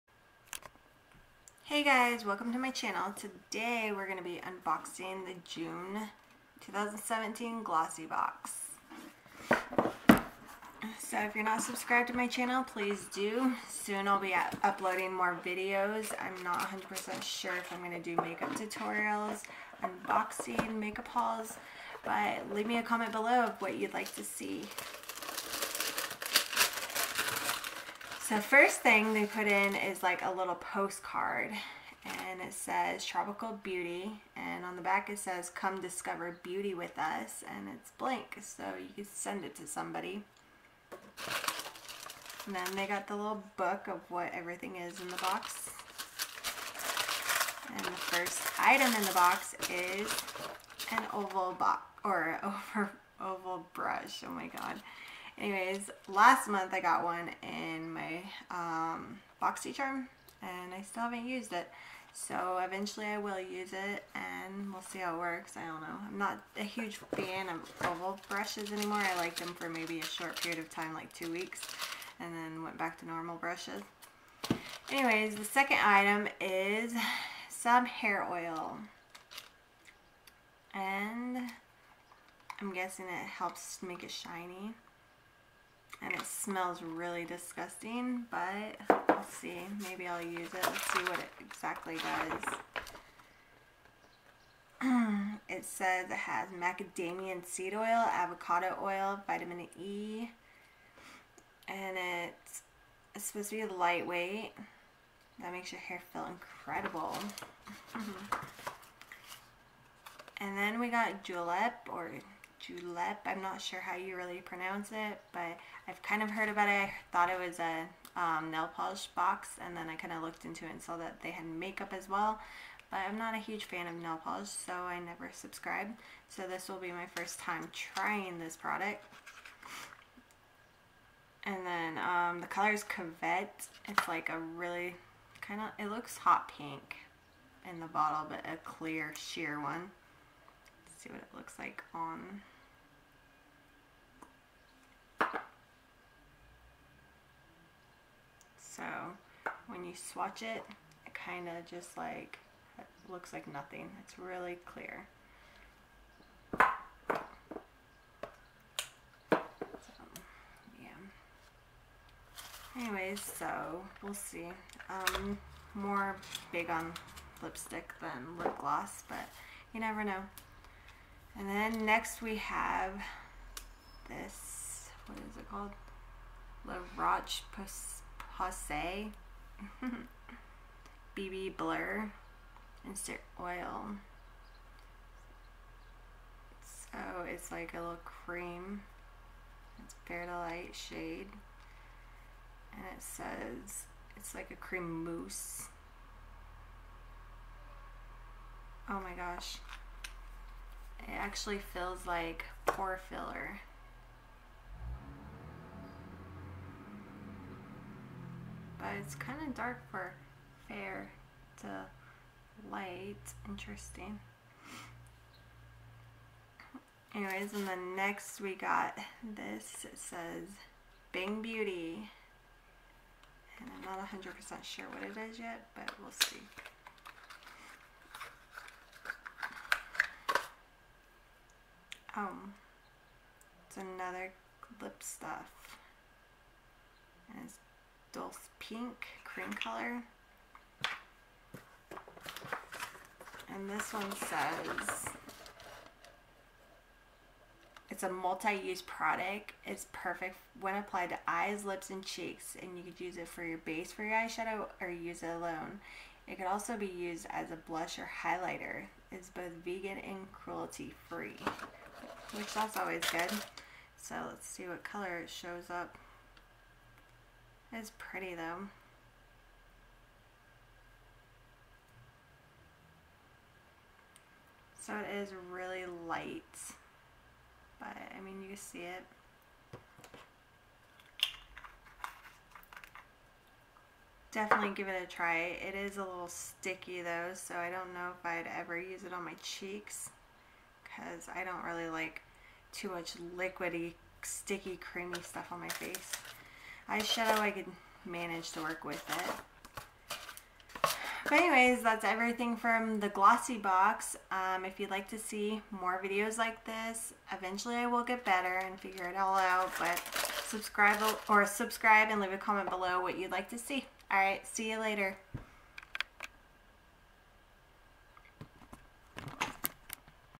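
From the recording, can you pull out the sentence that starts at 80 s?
And I'm guessing it helps make it shiny and it smells really disgusting, but let's see.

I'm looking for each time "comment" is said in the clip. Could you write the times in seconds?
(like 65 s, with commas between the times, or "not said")
22 s, 312 s.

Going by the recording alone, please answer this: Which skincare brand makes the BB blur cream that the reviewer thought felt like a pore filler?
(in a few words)
La Roche Posay.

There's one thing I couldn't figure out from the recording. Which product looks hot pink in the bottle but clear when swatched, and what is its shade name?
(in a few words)
Covette.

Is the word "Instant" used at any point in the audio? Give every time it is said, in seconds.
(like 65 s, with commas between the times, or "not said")
182 s.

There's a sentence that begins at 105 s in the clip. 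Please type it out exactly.
That makes your hair feel incredible.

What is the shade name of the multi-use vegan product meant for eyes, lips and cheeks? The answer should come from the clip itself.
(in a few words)
Dulce Pink.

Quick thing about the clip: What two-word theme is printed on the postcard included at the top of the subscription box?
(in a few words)
Tropical beauty.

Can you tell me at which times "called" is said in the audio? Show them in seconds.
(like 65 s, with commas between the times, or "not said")
175 s.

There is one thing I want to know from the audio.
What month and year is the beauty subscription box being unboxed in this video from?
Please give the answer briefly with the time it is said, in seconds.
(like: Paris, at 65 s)
June 2017, at 5 s.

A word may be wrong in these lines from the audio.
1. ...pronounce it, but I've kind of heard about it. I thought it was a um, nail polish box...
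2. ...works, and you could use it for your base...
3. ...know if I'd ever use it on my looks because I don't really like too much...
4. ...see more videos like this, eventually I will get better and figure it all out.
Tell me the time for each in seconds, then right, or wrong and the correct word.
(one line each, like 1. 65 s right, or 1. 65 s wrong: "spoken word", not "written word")
1. 114 s right
2. 252 s wrong: "cheeks", not "works"
3. 287 s wrong: "cheeks", not "looks"
4. 305 s right.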